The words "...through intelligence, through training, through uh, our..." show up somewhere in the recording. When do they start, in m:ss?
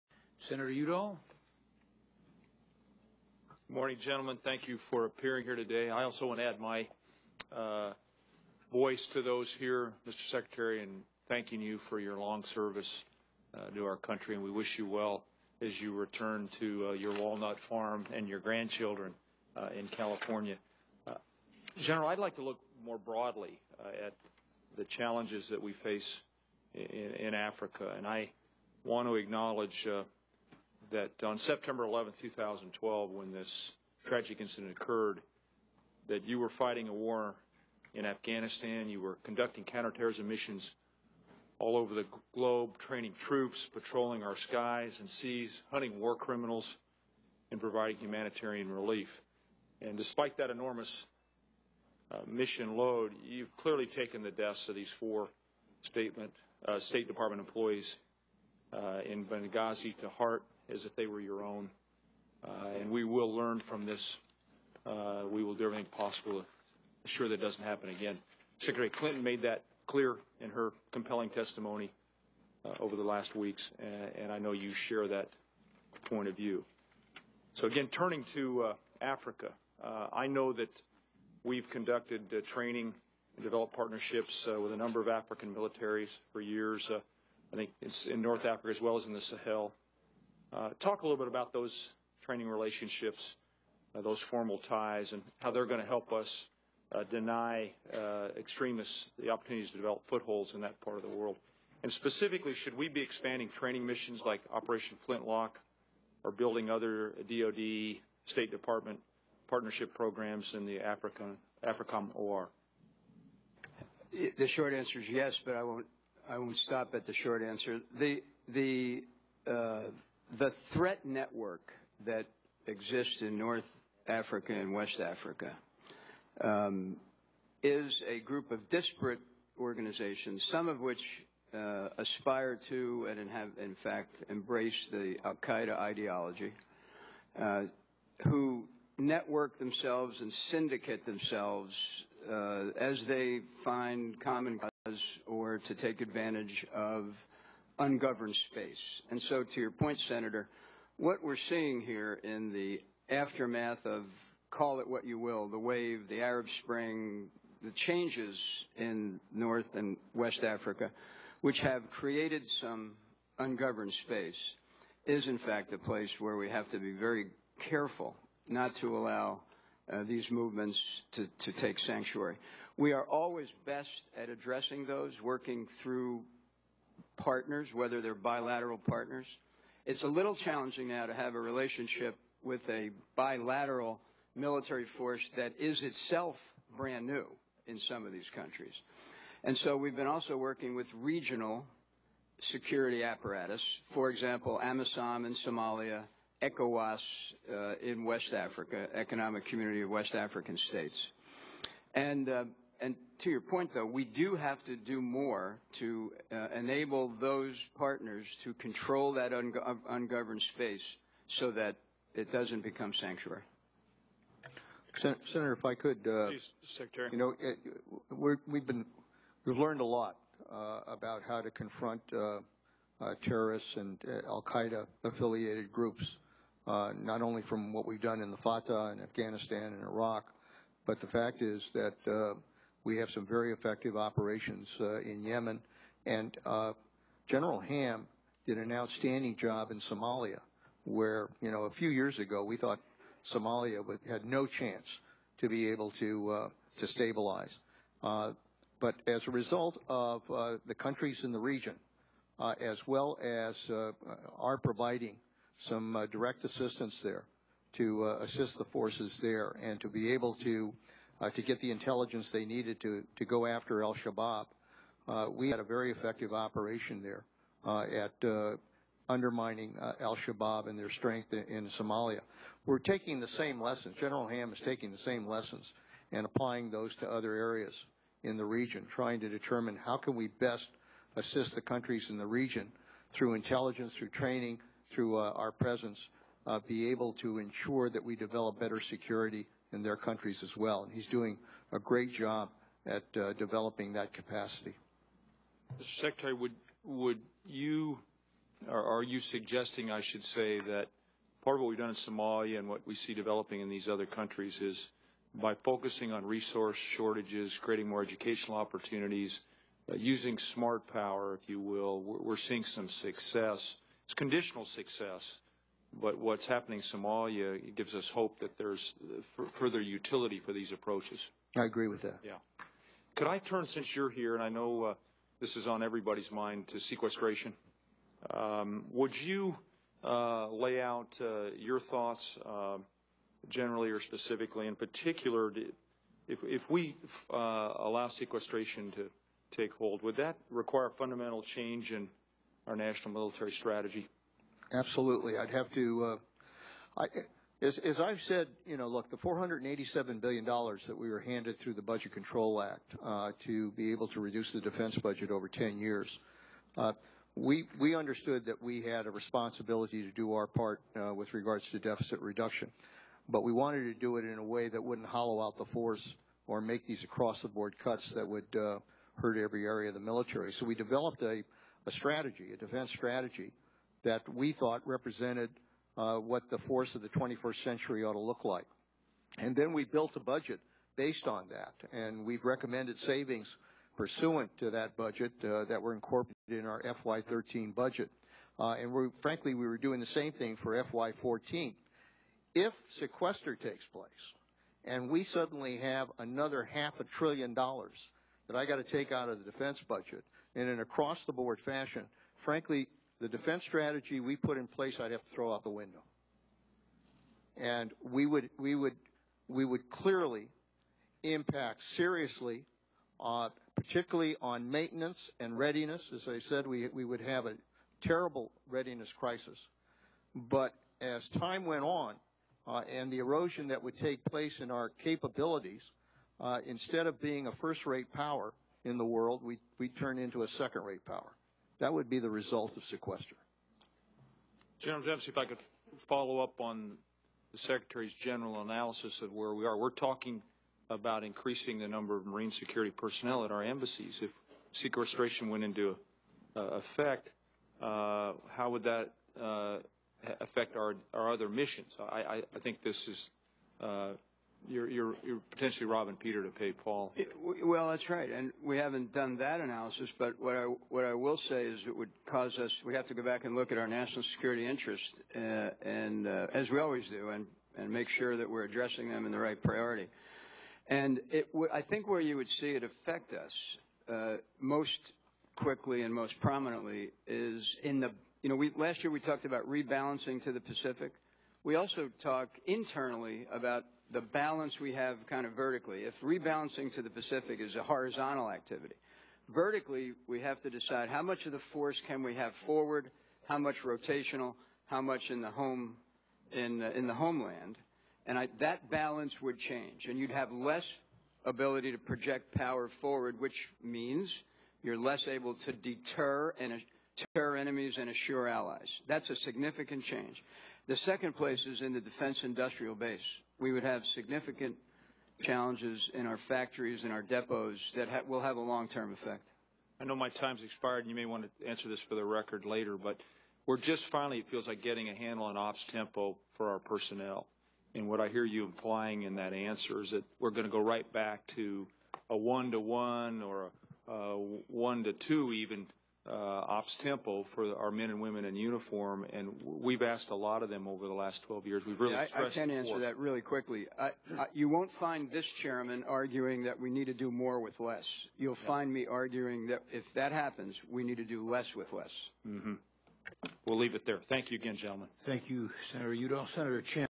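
4:43.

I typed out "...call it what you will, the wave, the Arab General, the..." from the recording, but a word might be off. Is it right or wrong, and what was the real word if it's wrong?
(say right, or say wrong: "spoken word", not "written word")
wrong: "Spring", not "General".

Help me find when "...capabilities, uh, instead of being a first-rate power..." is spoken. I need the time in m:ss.
7:04.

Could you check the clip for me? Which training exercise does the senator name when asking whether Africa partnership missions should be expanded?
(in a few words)
Operation Flintlock.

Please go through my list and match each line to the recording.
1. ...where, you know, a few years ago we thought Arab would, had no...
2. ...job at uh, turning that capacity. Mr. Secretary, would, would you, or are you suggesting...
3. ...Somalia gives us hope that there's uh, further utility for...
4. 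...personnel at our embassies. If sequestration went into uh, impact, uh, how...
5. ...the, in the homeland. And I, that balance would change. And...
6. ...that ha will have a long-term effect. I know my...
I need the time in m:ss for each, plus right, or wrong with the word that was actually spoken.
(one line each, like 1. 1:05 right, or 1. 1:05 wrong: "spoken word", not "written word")
1. 4:00 wrong: "Somalia", not "Arab"
2. 4:52 wrong: "developing", not "turning"
3. 5:16 right
4. 7:22 wrong: "effect", not "impact"
5. 8:16 right
6. 8:37 right.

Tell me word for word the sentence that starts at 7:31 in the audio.
I, I, I, think this is uh, you're, you're, you're potentially robbing Peter to pay Paul.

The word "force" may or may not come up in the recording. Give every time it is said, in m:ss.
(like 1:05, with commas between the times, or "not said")
3:04, 4:18, 6:05, 6:16, 8:11.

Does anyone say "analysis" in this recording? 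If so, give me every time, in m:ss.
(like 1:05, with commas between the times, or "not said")
7:18, 7:39.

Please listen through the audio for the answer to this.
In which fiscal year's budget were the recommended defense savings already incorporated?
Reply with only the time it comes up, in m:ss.
6:26.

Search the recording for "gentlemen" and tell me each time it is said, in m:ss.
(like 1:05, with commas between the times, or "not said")
0:03, 9:14.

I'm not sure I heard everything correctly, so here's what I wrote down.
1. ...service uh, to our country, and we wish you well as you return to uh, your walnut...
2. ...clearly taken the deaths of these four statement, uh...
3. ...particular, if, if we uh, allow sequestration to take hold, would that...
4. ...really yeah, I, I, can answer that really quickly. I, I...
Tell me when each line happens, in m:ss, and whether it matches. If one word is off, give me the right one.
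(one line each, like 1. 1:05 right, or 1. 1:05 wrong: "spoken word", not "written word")
1. 0:12 right
2. 0:53 right
3. 5:34 right
4. 9:01 right.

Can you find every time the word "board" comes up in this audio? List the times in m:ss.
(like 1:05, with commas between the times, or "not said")
6:07, 6:41.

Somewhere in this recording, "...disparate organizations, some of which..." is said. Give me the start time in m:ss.
2:08.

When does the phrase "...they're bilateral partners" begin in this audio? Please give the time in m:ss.
2:57.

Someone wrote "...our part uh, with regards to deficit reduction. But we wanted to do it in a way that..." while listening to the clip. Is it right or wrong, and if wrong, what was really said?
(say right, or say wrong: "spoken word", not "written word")
right.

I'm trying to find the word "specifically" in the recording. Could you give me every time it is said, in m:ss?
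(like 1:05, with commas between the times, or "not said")
1:41, 5:34.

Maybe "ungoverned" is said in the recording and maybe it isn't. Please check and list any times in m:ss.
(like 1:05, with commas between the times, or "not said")
2:27, 2:43, 3:29.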